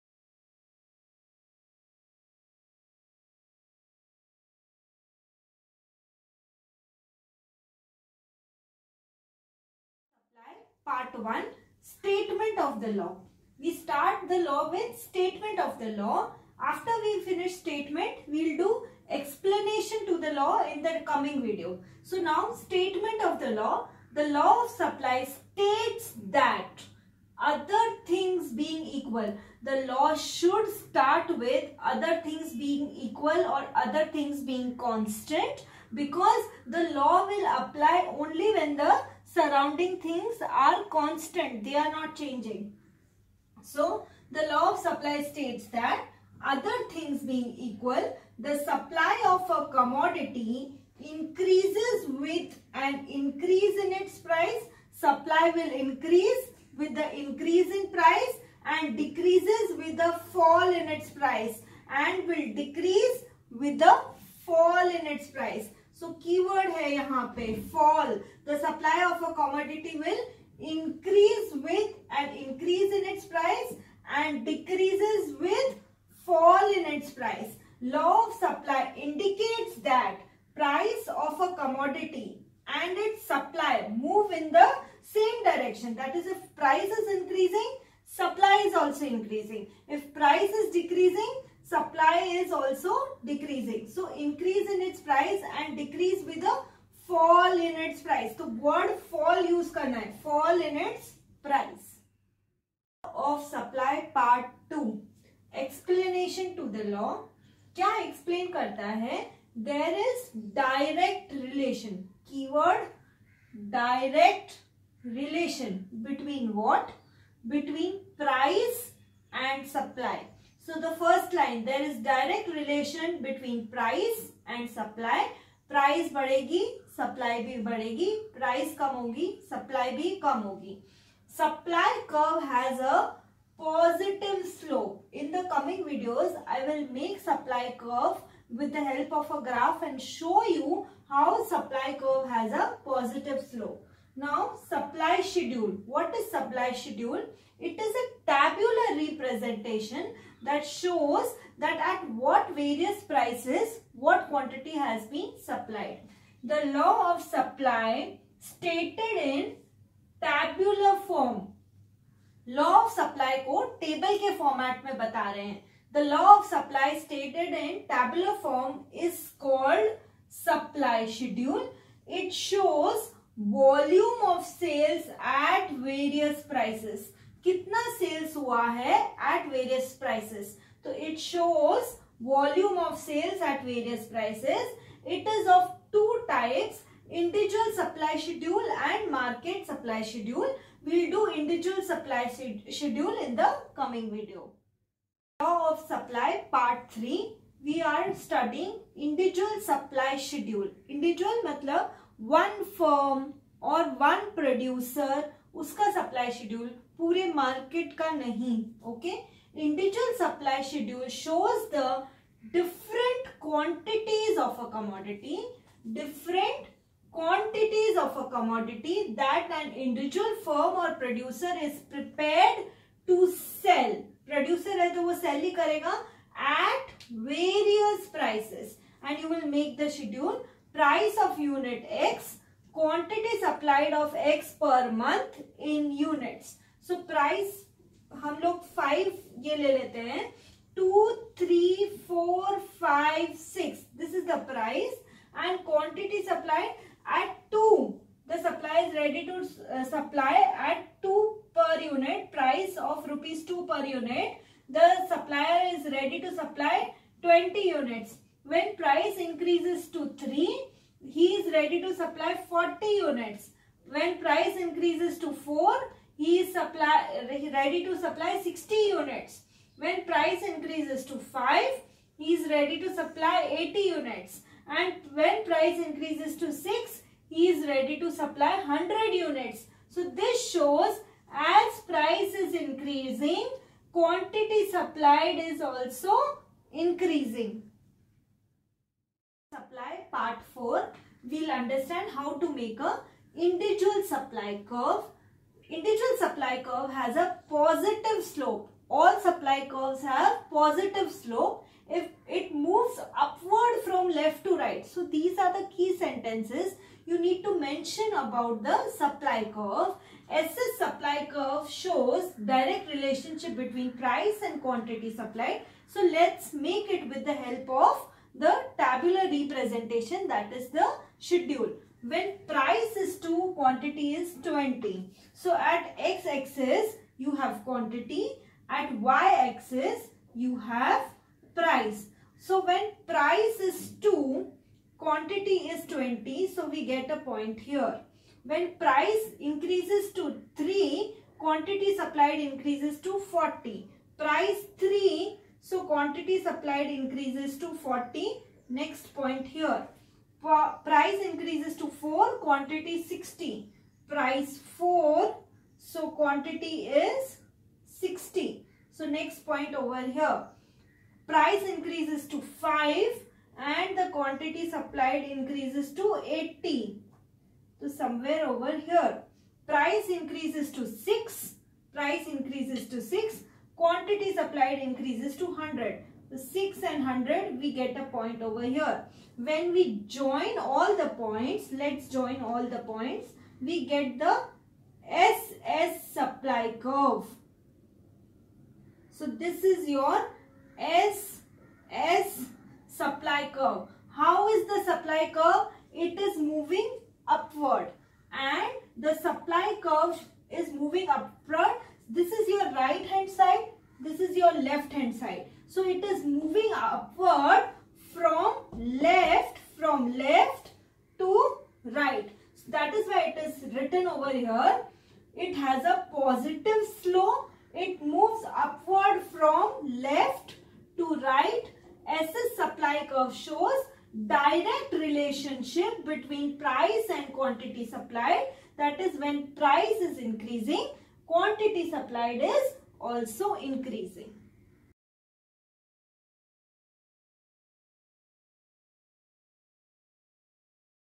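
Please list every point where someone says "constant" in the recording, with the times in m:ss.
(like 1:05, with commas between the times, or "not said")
0:34, 0:40.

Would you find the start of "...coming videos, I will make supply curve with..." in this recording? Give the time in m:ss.
2:15.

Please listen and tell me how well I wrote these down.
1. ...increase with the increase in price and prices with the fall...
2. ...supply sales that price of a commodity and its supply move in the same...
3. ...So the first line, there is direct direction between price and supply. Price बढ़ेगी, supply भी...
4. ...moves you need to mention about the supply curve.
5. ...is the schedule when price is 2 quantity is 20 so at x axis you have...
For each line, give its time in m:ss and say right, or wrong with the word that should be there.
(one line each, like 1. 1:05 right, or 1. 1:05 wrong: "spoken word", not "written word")
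1. 0:55 wrong: "decreases", not "prices"
2. 1:18 wrong: "indicates", not "sales"
3. 2:00 wrong: "relation", not "direction"
4. 5:05 wrong: "sentences", not "moves"
5. 5:20 right.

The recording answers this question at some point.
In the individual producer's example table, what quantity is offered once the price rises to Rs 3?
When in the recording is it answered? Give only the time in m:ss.
4:22.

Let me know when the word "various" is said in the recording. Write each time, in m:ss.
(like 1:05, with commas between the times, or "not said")
2:32, 2:55.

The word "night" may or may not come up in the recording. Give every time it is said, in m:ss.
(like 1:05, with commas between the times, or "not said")
not said.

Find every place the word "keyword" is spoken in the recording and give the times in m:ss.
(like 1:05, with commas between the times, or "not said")
1:06, 1:52.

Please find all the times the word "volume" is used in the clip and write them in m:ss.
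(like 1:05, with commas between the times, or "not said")
2:53.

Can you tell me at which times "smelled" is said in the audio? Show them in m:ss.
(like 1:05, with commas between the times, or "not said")
not said.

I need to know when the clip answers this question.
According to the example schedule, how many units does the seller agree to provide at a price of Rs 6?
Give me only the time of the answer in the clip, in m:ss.
4:38.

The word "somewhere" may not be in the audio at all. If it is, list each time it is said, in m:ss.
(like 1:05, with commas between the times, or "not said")
6:07.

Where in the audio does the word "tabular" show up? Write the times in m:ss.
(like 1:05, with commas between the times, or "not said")
2:28, 2:40, 2:47, 5:18.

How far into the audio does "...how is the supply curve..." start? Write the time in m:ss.
6:34.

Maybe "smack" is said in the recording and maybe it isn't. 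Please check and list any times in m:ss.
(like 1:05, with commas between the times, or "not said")
not said.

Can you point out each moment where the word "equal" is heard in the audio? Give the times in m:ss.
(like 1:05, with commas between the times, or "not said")
0:28, 0:33, 0:47.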